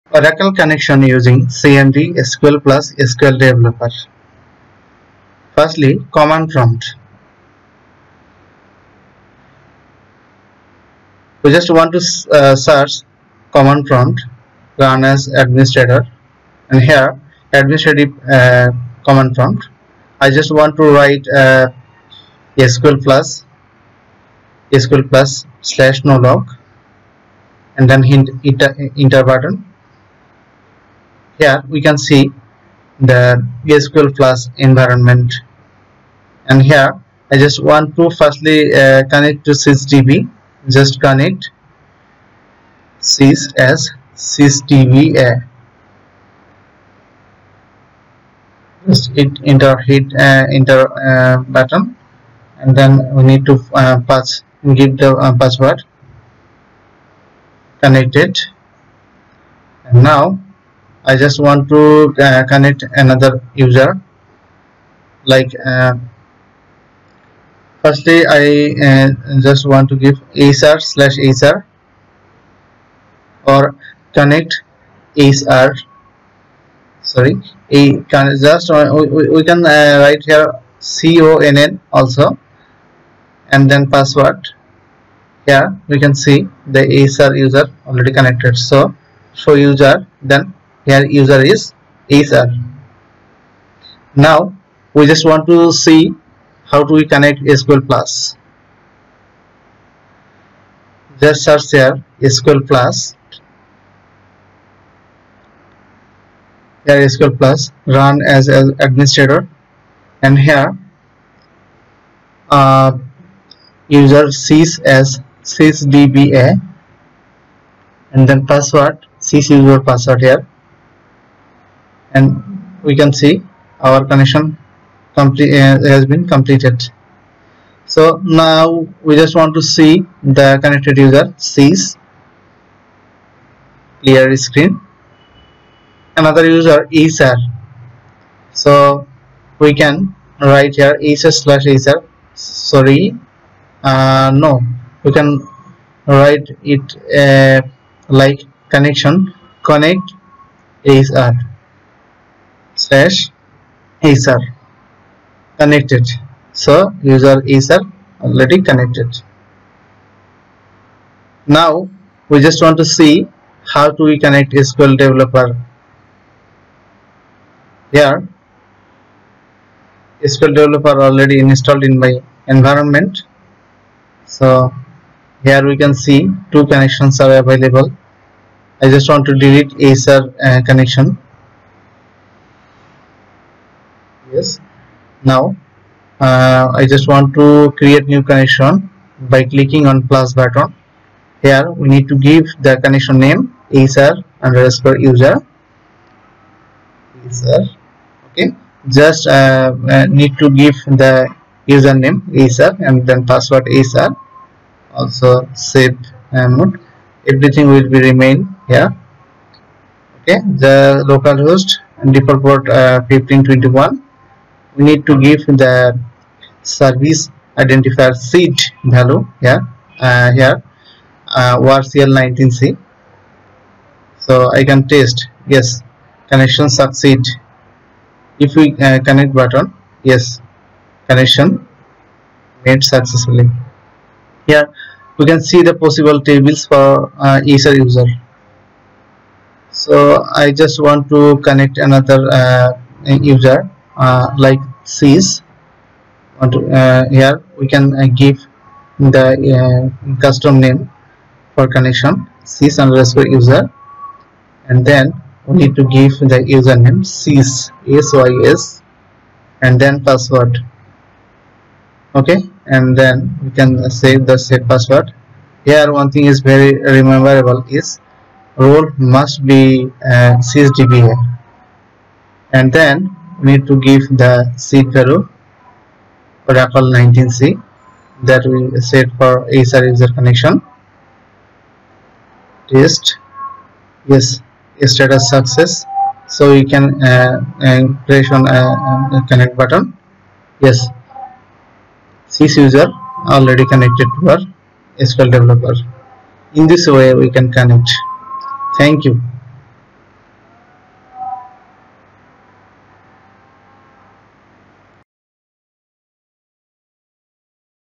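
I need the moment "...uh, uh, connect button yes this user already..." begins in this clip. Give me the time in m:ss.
4:48.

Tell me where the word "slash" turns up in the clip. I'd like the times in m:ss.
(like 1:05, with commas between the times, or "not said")
0:25, 1:10, 2:21, 2:32.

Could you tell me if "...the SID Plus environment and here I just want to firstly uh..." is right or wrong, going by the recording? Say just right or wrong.
wrong.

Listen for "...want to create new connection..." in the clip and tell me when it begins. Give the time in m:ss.
3:07.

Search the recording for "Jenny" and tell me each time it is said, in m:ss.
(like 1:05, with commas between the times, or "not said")
not said.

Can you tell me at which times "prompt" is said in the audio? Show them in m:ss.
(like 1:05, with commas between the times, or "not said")
0:06, 0:13, 0:19.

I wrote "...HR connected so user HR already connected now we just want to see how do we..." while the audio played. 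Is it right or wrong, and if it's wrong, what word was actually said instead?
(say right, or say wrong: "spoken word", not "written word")
right.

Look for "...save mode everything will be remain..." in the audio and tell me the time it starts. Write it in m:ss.
3:25.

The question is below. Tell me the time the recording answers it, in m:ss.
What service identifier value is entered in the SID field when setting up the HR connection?
3:41.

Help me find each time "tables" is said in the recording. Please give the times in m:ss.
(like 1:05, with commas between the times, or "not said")
3:56.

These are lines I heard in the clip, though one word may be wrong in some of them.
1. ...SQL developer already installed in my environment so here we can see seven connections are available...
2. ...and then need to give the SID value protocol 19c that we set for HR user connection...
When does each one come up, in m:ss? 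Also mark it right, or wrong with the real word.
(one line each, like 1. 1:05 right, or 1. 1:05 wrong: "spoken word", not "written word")
1. 2:50 wrong: "two", not "seven"
2. 4:32 right.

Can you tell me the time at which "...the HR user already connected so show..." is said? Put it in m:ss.
1:26.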